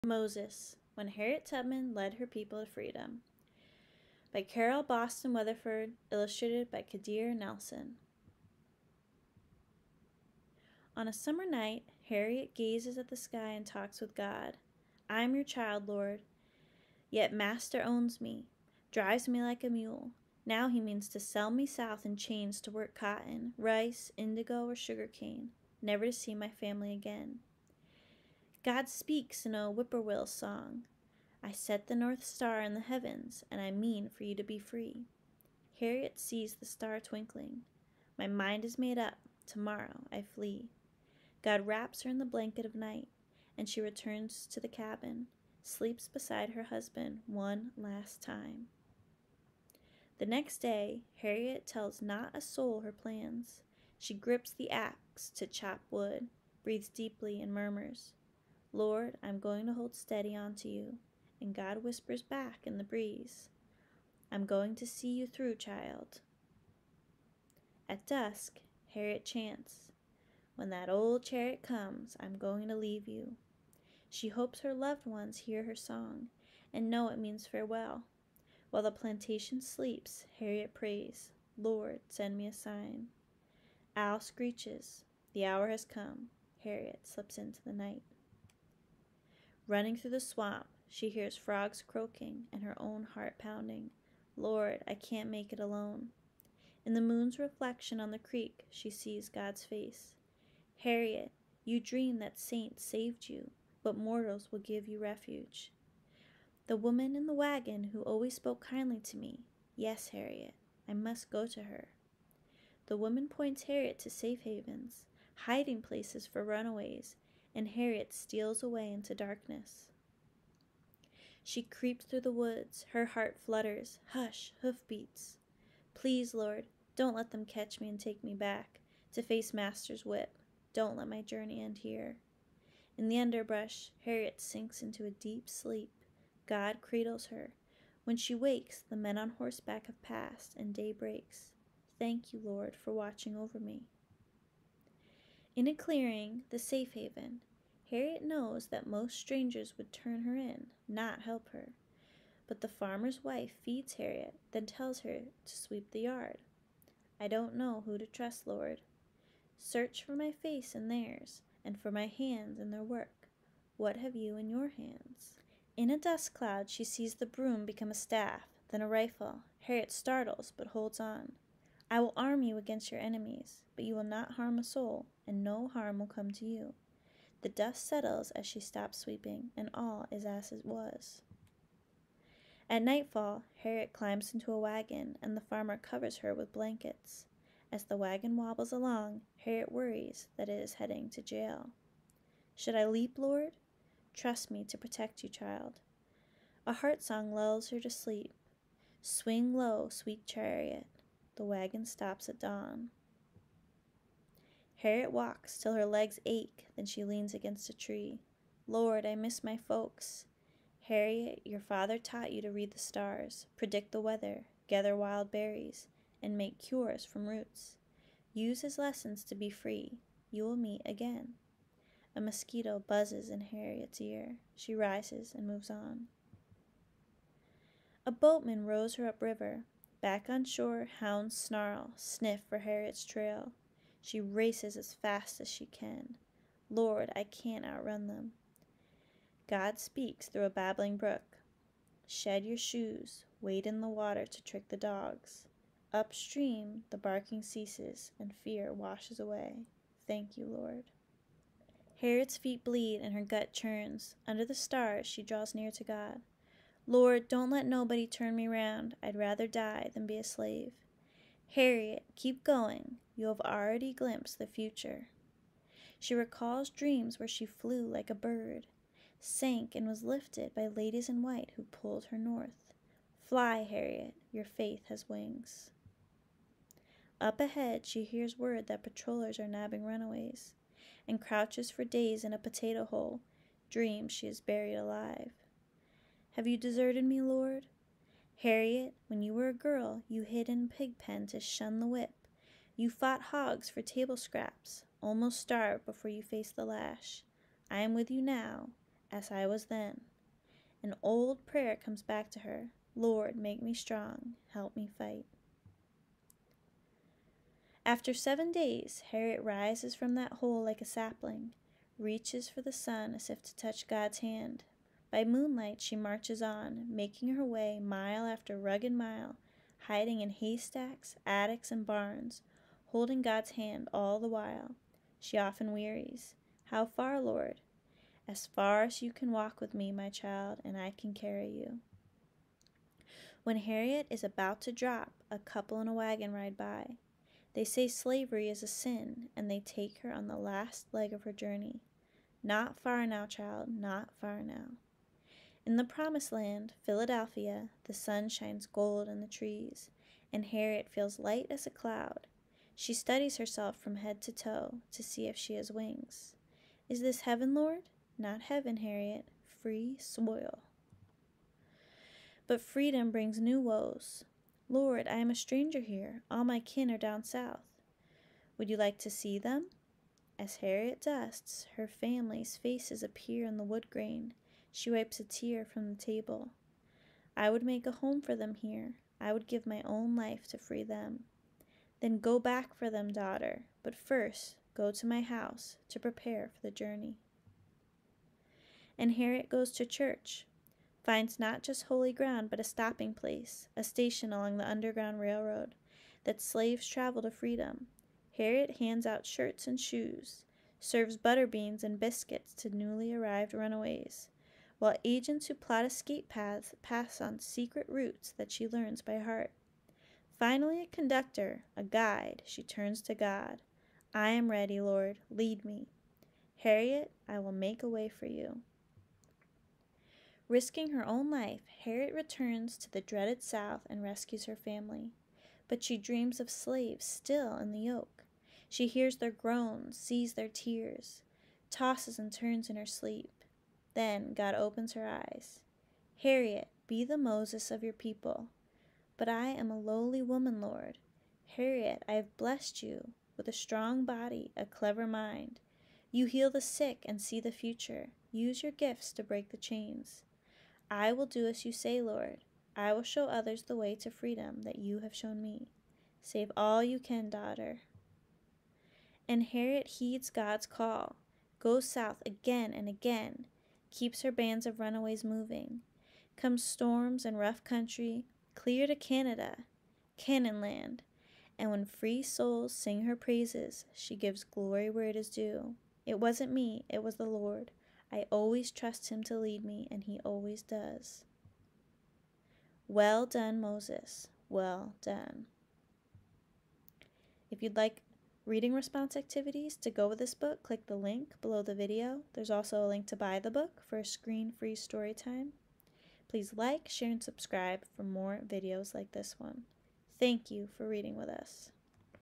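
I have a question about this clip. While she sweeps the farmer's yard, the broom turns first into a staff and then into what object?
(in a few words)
A rifle.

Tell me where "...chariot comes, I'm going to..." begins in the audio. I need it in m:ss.
1:11.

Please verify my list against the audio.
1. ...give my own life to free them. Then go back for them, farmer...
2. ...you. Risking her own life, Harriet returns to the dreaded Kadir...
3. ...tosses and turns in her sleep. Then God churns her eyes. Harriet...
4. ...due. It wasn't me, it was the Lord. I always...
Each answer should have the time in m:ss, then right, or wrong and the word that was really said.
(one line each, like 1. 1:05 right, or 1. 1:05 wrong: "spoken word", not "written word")
1. 6:19 wrong: "daughter", not "farmer"
2. 6:58 wrong: "South", not "Kadir"
3. 7:11 wrong: "opens", not "churns"
4. 7:55 right.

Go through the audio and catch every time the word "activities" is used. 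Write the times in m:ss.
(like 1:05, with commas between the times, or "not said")
8:09.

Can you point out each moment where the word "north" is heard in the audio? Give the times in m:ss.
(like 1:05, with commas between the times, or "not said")
0:31, 4:32.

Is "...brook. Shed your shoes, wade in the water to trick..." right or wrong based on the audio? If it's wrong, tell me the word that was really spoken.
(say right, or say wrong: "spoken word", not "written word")
right.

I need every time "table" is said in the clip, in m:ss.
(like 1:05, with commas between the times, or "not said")
4:53, 6:16.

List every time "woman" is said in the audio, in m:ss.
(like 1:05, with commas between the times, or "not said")
1:46, 1:52, 7:20.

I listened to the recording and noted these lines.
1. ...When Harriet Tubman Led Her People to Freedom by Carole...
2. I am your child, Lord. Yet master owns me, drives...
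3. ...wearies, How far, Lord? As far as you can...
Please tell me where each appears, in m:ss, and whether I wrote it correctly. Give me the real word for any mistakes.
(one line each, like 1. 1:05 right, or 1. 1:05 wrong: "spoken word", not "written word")
1. 0:00 right
2. 0:15 right
3. 5:25 right.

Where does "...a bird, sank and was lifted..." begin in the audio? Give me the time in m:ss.
4:28.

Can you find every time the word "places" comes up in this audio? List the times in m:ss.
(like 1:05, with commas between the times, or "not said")
1:55, 6:33.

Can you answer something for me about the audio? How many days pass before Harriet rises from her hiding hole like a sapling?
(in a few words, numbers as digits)
7.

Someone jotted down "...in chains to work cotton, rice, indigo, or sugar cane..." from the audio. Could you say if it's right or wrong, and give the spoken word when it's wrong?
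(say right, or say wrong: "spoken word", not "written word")
right.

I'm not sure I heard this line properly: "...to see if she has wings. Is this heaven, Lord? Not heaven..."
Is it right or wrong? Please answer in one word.
right.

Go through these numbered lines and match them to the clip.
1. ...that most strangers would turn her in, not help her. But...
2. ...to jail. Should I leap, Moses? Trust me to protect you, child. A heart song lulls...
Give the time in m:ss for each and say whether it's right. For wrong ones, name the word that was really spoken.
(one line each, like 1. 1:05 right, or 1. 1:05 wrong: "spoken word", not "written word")
1. 2:28 right
2. 3:11 wrong: "Lord", not "Moses".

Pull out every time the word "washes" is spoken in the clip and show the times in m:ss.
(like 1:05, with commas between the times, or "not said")
4:08.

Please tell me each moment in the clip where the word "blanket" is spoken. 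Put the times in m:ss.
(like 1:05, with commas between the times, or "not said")
0:42, 3:06.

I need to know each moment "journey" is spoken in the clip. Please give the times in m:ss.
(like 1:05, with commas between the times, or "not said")
2:11, 5:41, 6:26.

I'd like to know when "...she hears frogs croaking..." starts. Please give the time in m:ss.
1:30.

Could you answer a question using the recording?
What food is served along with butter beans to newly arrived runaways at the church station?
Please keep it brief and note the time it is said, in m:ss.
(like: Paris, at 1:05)
Biscuits, at 6:41.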